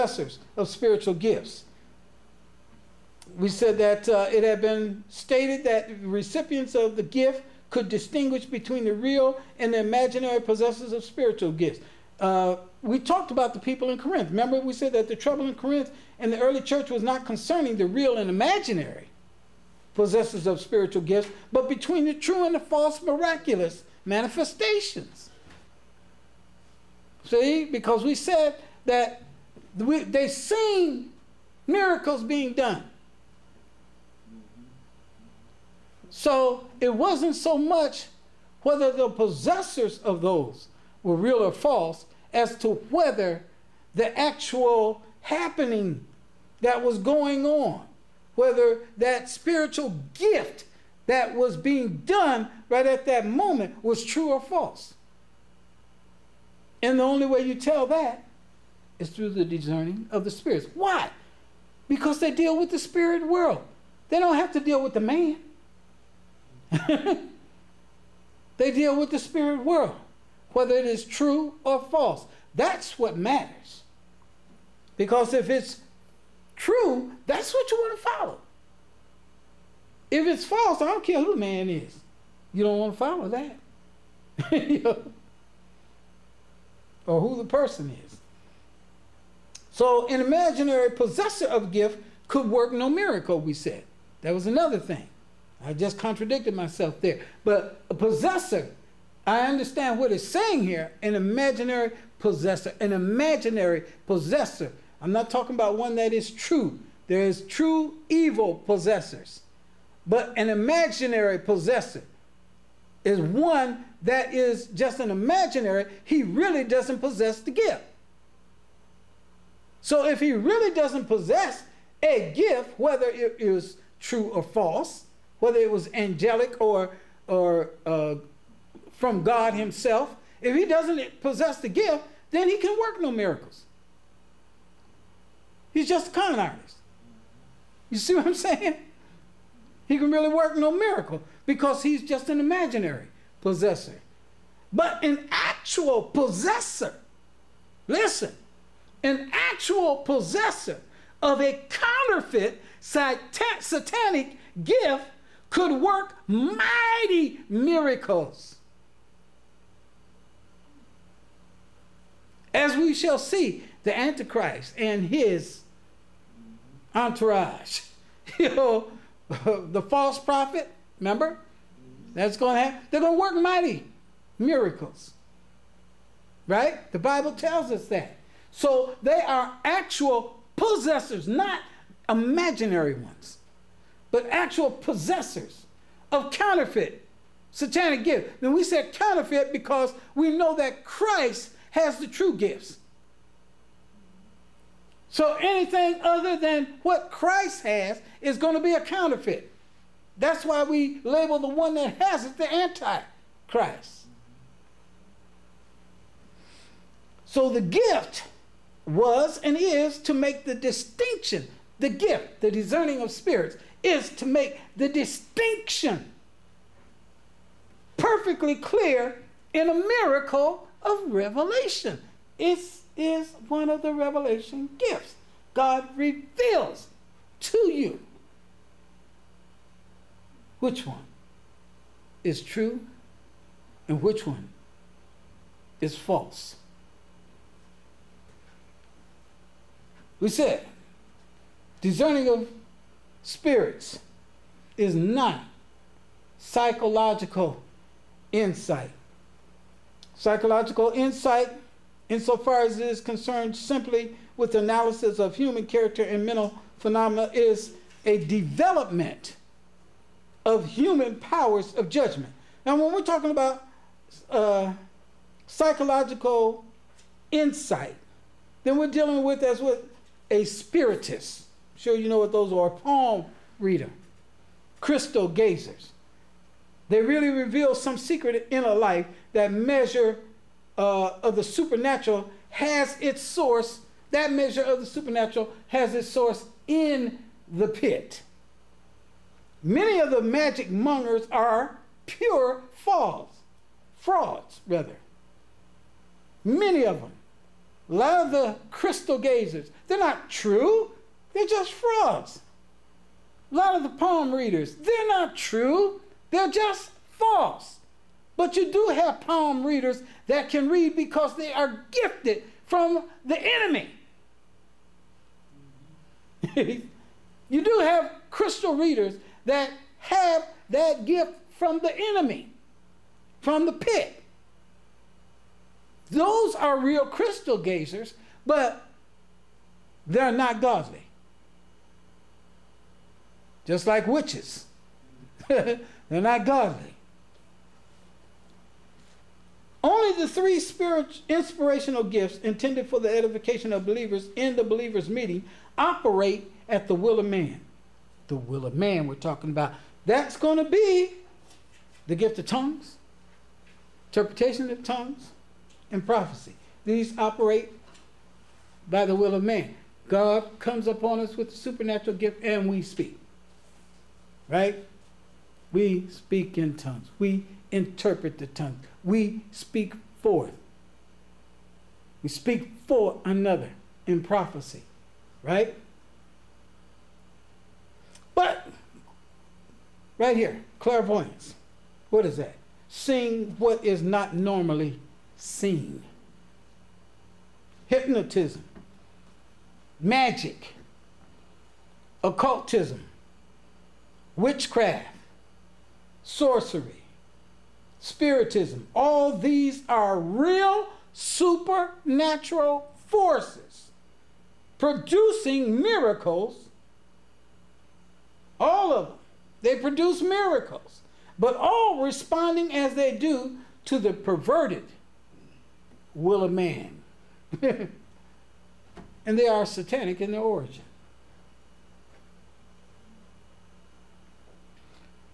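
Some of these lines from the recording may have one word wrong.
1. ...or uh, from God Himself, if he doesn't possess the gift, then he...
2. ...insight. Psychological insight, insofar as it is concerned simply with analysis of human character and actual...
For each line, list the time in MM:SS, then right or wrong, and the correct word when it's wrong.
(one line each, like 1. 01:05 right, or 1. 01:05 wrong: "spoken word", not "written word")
1. 02:07 right
2. 04:08 wrong: "mental", not "actual".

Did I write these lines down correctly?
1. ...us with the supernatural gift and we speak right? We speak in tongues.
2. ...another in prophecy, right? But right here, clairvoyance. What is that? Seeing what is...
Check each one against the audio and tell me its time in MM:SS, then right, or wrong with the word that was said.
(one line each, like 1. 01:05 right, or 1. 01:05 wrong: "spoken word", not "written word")
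1. 06:01 right
2. 06:13 right.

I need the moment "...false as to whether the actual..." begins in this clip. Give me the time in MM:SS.
00:41.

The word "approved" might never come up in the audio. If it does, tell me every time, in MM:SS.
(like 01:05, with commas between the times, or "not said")
not said.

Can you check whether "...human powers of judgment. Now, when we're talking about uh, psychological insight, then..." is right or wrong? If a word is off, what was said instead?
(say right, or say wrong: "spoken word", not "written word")
right.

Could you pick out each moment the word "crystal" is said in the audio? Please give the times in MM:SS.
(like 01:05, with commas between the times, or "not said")
04:34, 04:58, 05:18, 05:27.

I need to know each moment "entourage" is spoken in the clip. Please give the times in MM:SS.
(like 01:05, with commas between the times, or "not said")
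02:46.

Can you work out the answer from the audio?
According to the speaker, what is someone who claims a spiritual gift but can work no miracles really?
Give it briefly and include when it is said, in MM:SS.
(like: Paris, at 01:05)
A con artist, at 02:16.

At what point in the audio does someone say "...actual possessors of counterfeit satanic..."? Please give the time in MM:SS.
03:04.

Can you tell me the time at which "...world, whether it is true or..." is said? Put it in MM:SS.
01:09.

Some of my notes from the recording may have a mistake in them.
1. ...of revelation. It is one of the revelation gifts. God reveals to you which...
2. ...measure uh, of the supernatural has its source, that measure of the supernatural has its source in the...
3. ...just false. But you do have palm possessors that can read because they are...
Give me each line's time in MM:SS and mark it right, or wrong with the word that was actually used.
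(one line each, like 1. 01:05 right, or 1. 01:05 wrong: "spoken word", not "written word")
1. 03:40 right
2. 04:39 right
3. 05:06 wrong: "readers", not "possessors".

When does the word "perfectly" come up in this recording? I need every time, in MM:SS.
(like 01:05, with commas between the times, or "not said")
03:37.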